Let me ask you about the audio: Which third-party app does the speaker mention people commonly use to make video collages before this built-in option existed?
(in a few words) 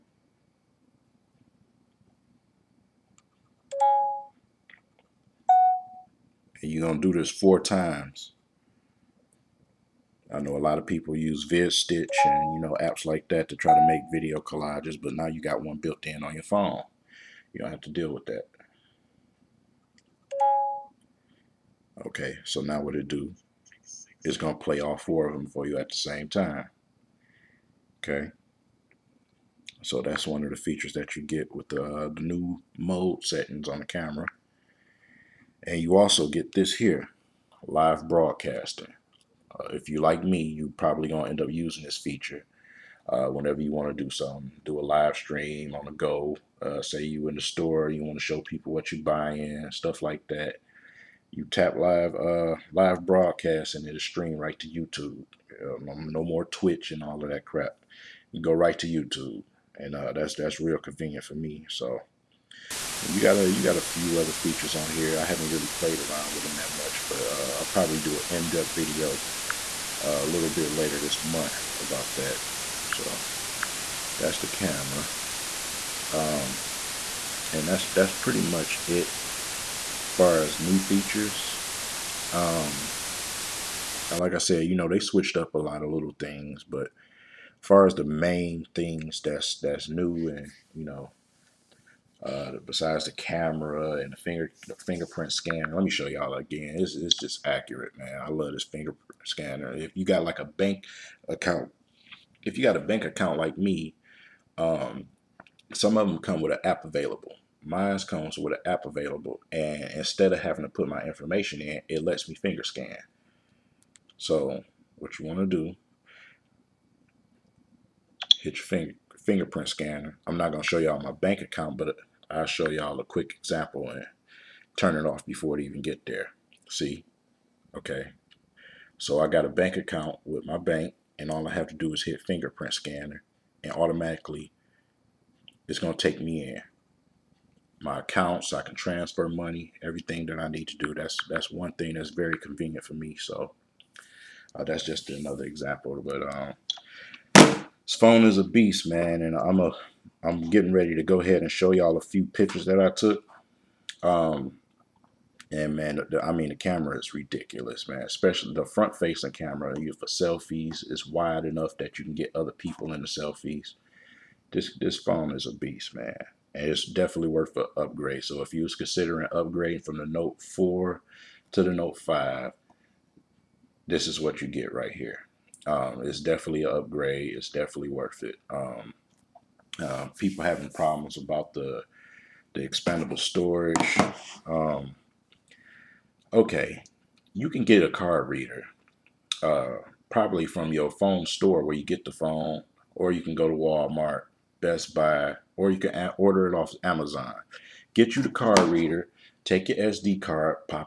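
VidStitch.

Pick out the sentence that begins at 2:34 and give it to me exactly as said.
Um, and man, the, I mean, the camera is ridiculous, man.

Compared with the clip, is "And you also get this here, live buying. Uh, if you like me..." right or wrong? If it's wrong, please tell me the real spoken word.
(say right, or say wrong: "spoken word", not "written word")
wrong: "broadcasting", not "buying".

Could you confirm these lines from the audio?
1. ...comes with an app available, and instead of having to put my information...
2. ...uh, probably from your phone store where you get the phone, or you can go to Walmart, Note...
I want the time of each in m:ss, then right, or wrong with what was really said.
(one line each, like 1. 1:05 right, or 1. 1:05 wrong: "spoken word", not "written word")
1. 1:47 right
2. 3:09 wrong: "Best", not "Note".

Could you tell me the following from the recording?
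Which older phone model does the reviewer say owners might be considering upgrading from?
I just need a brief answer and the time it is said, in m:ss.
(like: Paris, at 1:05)
Note 4, at 2:50.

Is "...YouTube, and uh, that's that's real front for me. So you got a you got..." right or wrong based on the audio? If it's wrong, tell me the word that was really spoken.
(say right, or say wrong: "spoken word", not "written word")
wrong: "convenient", not "front".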